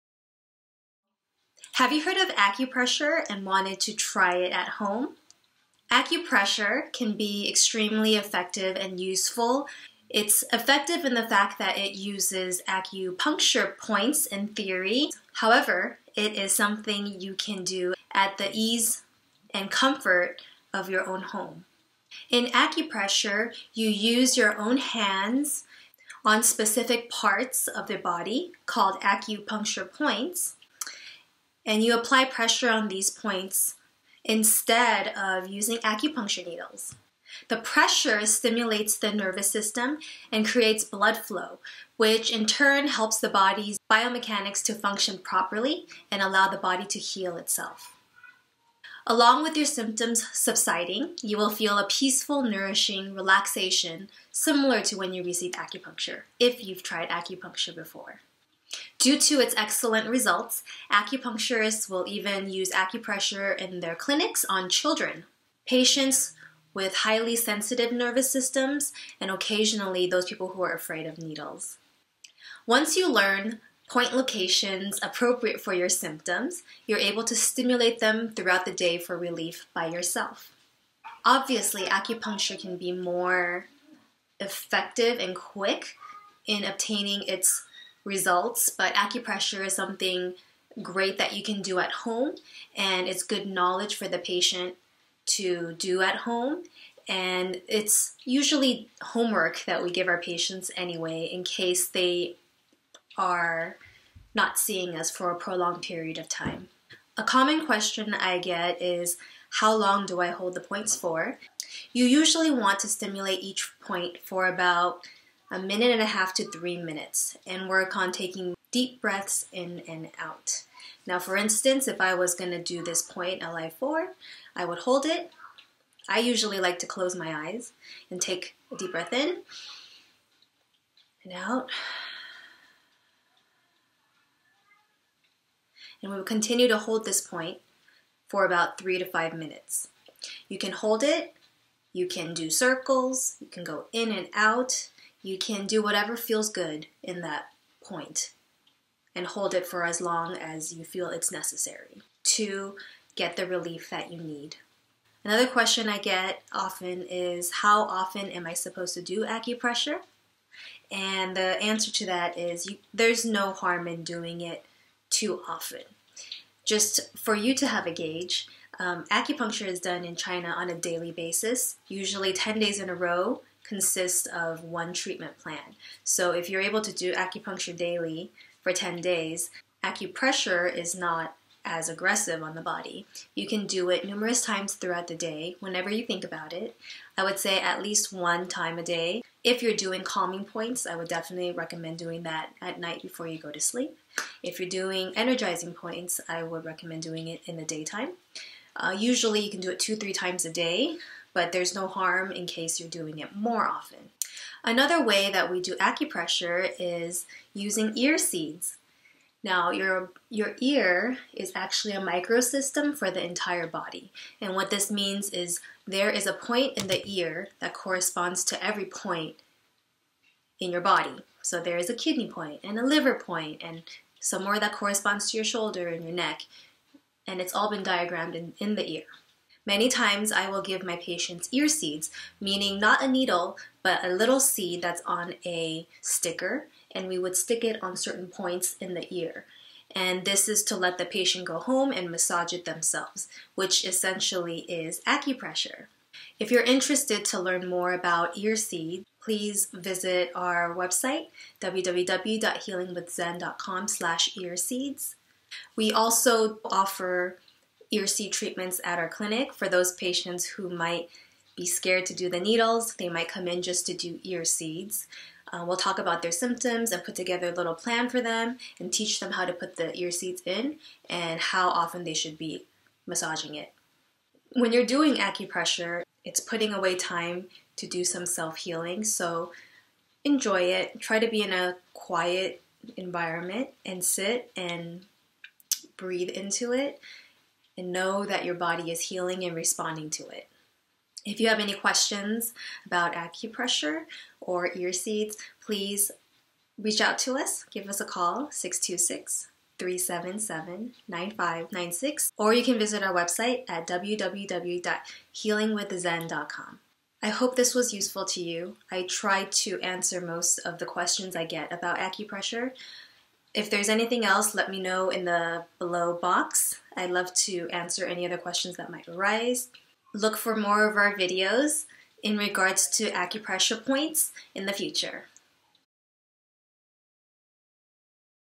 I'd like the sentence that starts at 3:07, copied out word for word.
I would say at least one time a day.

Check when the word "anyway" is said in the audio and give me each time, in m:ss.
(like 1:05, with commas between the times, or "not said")
1:40.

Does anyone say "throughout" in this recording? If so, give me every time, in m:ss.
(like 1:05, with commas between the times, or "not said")
1:18, 3:04.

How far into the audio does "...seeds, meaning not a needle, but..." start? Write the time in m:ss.
3:51.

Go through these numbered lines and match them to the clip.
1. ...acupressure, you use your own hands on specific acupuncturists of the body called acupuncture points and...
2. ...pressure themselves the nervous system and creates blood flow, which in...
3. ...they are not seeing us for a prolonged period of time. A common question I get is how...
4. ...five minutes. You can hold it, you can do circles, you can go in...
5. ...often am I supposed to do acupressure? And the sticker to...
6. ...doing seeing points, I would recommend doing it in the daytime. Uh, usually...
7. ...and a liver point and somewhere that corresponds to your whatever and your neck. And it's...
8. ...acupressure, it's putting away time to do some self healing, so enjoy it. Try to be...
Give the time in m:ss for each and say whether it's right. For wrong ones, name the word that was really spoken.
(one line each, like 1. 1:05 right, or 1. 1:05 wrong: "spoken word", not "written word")
1. 0:22 wrong: "parts", not "acupuncturists"
2. 0:37 wrong: "stimulates", not "themselves"
3. 1:41 right
4. 2:19 right
5. 2:37 wrong: "answer", not "sticker"
6. 3:14 wrong: "energizing", not "seeing"
7. 3:42 wrong: "shoulder", not "whatever"
8. 4:35 right.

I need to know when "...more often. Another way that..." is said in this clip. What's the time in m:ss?
3:23.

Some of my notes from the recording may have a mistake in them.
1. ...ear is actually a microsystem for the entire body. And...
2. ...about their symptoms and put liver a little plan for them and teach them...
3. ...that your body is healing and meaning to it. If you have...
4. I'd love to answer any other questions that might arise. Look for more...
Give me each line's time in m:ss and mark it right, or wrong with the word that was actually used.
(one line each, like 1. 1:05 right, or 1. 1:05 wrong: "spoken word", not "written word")
1. 3:30 right
2. 4:25 wrong: "together", not "liver"
3. 4:48 wrong: "responding", not "meaning"
4. 5:16 right.